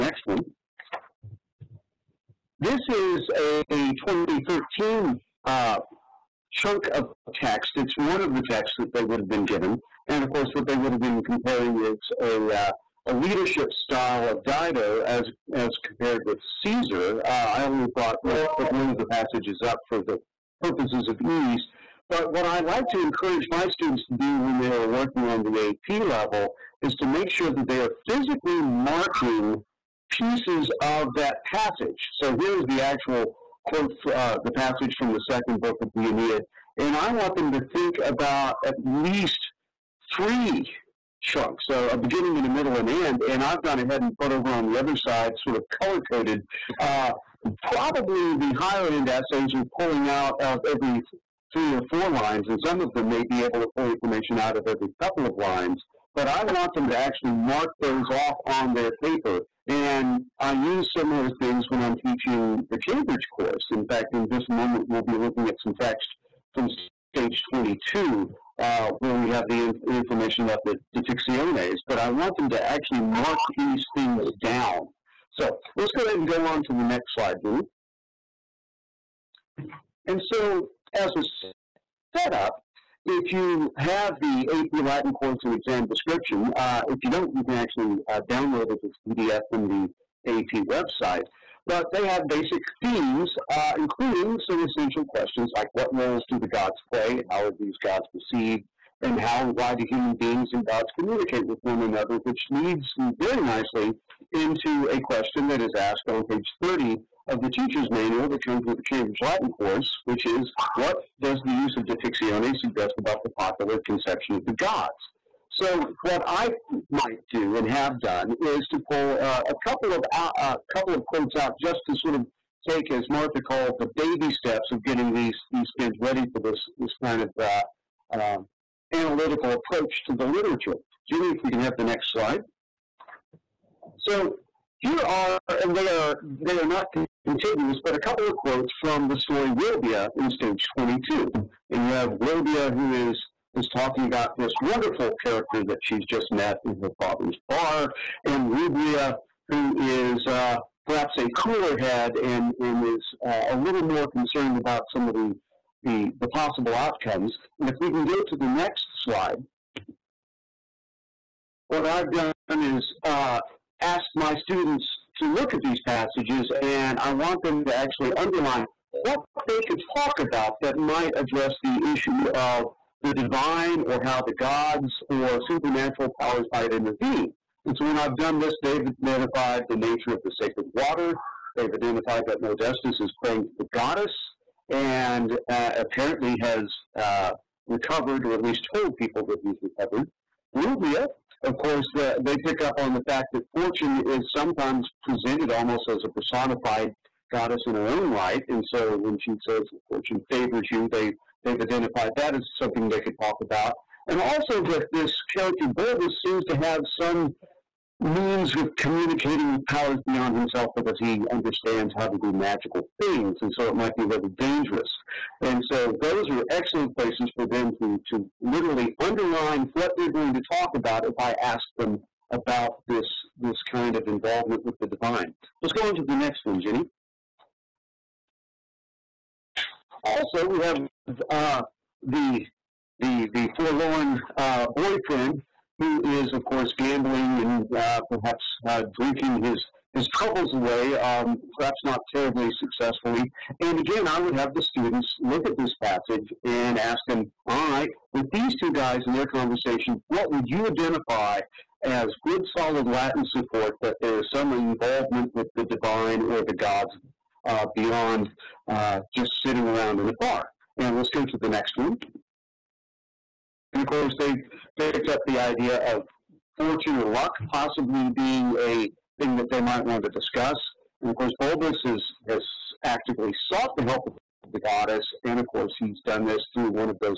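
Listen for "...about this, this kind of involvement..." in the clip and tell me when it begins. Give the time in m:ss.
3:42.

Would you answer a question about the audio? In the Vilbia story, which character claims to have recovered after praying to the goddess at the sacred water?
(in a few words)
Modestus.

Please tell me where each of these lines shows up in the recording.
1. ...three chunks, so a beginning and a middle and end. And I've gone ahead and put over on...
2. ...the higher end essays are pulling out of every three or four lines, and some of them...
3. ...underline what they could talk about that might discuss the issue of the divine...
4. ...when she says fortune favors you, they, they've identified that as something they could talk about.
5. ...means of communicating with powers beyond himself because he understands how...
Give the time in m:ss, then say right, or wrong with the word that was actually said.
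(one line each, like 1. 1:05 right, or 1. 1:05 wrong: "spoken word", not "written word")
1. 0:40 right
2. 0:48 right
3. 2:48 wrong: "address", not "discuss"
4. 3:19 right
5. 3:28 right.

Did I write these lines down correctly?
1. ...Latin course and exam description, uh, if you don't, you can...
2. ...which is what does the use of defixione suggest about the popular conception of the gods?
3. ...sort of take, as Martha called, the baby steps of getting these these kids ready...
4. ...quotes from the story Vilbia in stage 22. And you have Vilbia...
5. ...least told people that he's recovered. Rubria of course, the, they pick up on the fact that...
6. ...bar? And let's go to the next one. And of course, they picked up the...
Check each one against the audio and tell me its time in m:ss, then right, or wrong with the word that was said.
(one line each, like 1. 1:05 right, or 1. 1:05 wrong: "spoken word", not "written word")
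1. 1:24 right
2. 1:50 right
3. 2:01 right
4. 2:18 right
5. 3:08 right
6. 4:20 right.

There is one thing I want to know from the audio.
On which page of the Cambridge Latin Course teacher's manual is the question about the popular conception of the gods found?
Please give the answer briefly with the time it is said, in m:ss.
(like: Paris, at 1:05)
30, at 1:46.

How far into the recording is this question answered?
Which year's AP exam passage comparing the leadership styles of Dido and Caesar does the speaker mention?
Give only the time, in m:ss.
0:04.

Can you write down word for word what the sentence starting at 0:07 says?
It's one of the texts that they would have been given.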